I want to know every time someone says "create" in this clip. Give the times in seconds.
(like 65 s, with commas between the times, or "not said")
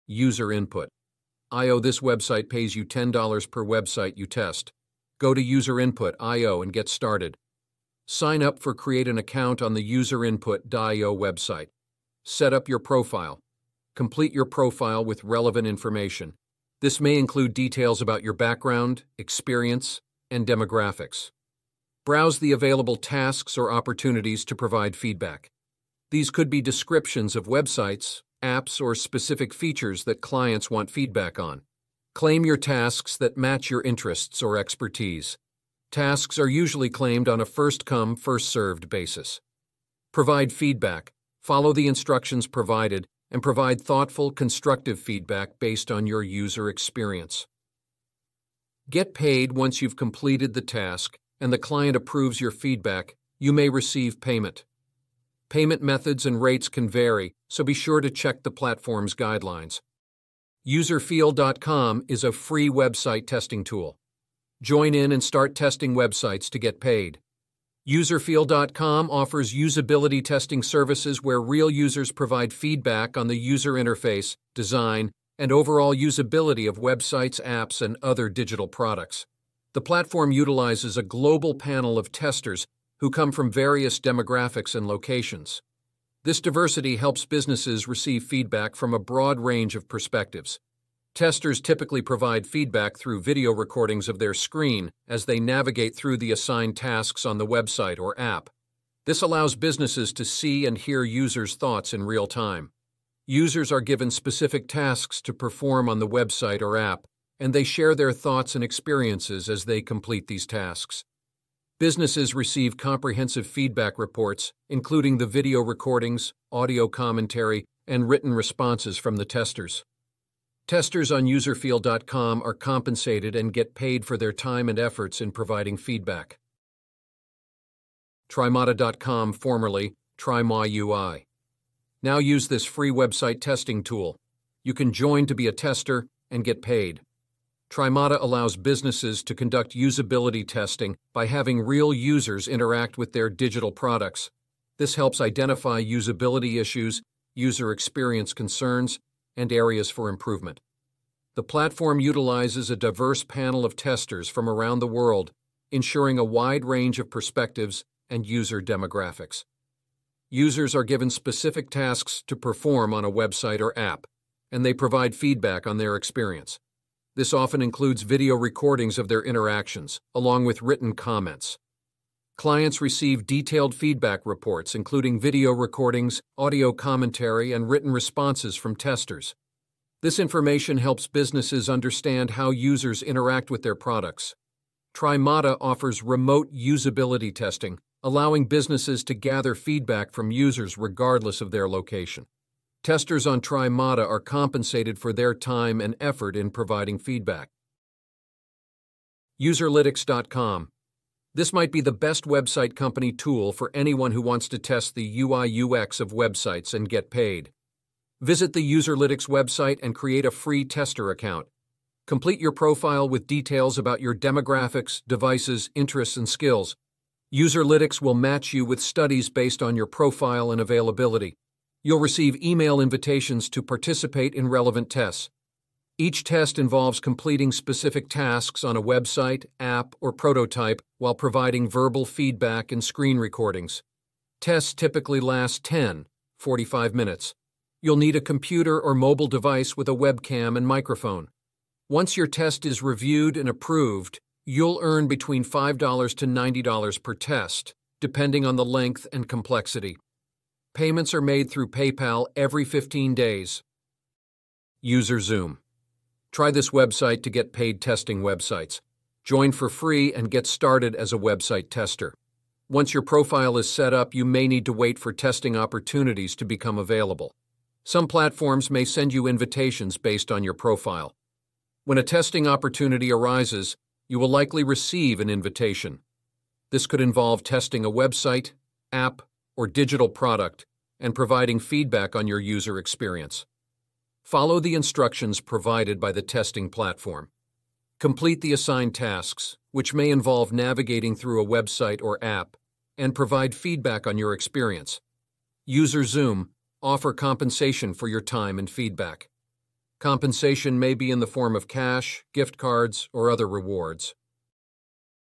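8 s, 209 s.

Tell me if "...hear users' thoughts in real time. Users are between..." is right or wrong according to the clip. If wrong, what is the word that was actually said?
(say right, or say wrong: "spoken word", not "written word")
wrong: "given", not "between".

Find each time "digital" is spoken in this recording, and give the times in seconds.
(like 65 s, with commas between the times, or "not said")
78 s, 143 s, 279 s.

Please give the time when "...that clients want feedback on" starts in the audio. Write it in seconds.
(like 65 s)
30 s.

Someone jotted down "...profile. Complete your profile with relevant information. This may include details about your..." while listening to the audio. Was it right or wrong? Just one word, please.
right.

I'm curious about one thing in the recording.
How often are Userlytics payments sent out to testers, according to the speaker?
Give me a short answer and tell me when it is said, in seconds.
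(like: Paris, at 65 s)
every 15 days, at 252 s.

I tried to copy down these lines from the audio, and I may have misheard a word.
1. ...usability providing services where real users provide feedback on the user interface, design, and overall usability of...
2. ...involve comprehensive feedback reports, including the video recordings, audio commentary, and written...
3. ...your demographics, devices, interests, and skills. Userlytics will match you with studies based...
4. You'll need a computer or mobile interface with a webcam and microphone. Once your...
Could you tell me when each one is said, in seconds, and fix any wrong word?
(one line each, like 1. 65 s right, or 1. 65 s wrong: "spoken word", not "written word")
1. 69 s wrong: "testing", not "providing"
2. 112 s wrong: "receive", not "involve"
3. 214 s right
4. 237 s wrong: "device", not "interface".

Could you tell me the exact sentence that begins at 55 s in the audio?
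Payment methods and rates can vary, so be sure to check the platform's guidelines.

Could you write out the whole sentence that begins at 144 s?
This helps identify usability issues, user experience concerns, and areas for improvement.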